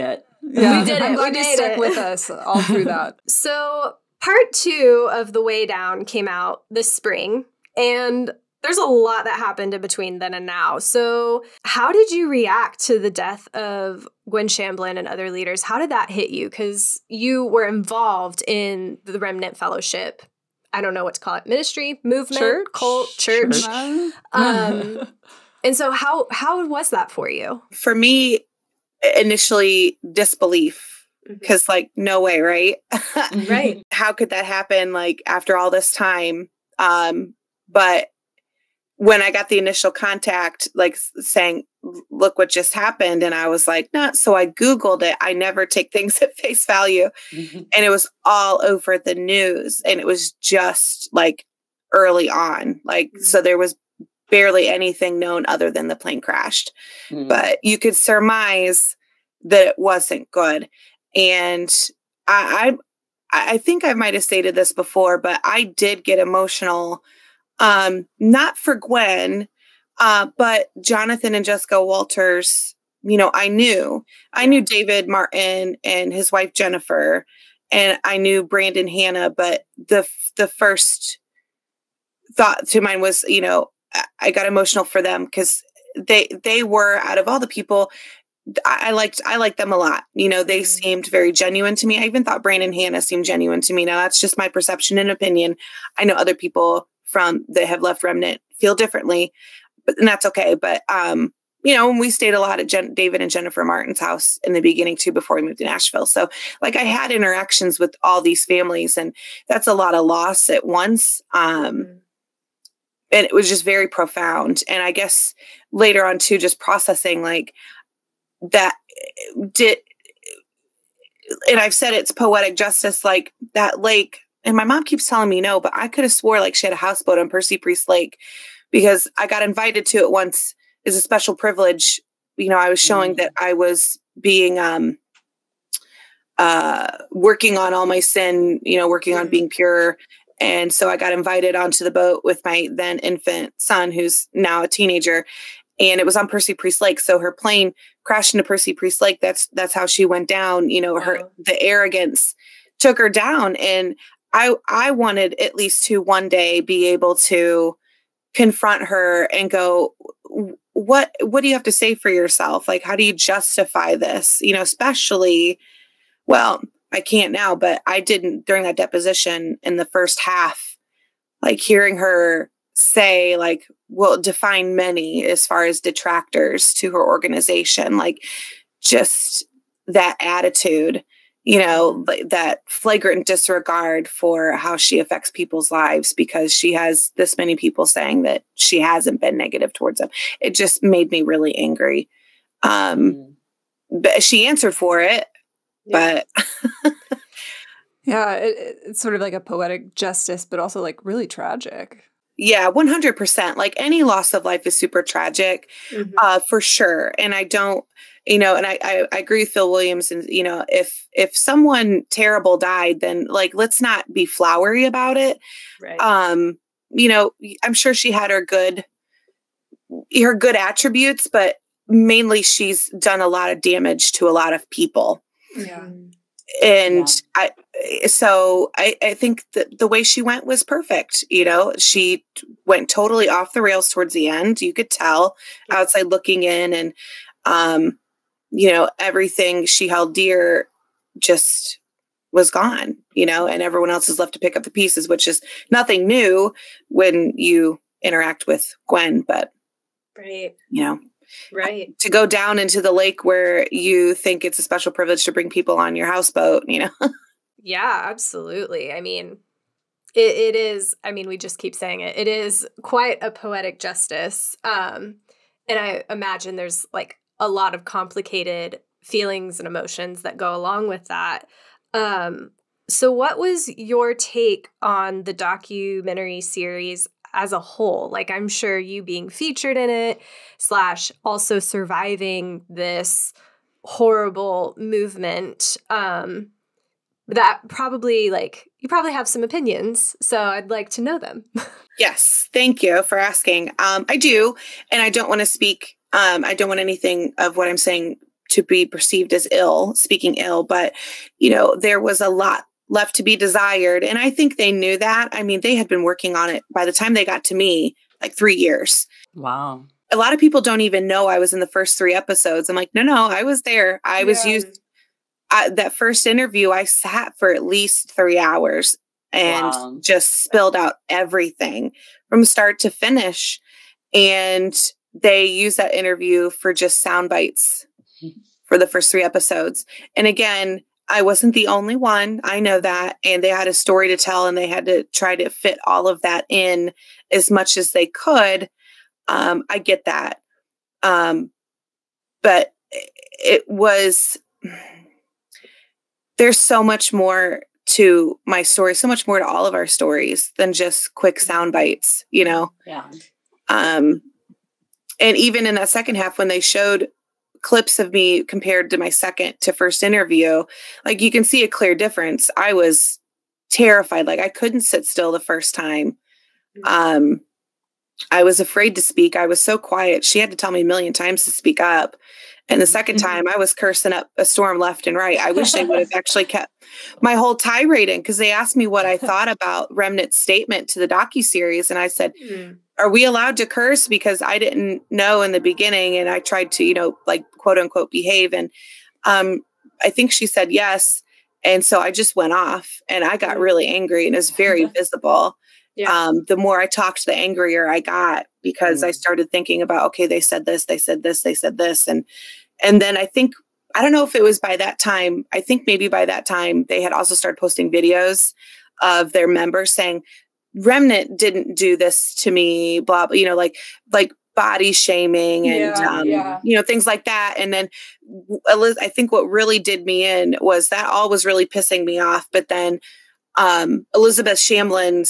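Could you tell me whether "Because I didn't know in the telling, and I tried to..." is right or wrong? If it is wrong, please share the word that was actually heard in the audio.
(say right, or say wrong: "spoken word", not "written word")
wrong: "beginning", not "telling".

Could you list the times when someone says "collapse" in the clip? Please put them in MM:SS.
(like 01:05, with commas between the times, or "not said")
not said.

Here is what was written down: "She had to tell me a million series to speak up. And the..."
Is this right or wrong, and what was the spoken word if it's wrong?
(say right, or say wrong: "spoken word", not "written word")
wrong: "times", not "series".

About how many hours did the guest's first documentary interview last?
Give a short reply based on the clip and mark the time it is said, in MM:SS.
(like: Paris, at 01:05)
3 hours, at 05:18.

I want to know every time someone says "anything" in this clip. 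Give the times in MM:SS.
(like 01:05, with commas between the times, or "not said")
00:54, 04:56.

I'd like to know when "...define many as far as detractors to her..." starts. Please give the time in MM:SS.
02:54.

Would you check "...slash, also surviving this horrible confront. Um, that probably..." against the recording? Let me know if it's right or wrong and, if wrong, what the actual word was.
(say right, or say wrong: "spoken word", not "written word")
wrong: "movement", not "confront".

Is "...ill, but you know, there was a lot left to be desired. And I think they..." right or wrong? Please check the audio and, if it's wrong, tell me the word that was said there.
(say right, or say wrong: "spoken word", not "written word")
right.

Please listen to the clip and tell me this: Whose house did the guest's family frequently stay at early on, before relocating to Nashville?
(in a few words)
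David and Jennifer Martin.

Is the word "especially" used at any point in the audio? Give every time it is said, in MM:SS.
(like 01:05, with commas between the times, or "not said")
02:44.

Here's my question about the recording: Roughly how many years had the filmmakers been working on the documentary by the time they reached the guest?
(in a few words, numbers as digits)
3 years.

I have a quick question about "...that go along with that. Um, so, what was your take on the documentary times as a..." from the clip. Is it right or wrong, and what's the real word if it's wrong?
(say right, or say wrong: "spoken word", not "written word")
wrong: "series", not "times".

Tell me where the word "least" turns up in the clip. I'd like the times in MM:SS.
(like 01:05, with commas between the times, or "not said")
02:35, 05:17.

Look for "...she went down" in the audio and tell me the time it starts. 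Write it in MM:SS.
02:29.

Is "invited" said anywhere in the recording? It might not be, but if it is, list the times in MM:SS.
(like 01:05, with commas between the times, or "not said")
02:09, 02:21.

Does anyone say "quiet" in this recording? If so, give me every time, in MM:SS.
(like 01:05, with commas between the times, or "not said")
06:09.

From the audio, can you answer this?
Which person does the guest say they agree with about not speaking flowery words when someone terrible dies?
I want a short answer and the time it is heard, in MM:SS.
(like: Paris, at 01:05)
Phil Williams, at 03:29.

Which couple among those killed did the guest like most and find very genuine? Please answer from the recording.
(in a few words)
Jonathan and Jessica Walters.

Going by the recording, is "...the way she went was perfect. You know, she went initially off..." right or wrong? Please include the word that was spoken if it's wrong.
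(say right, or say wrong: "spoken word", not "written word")
wrong: "totally", not "initially".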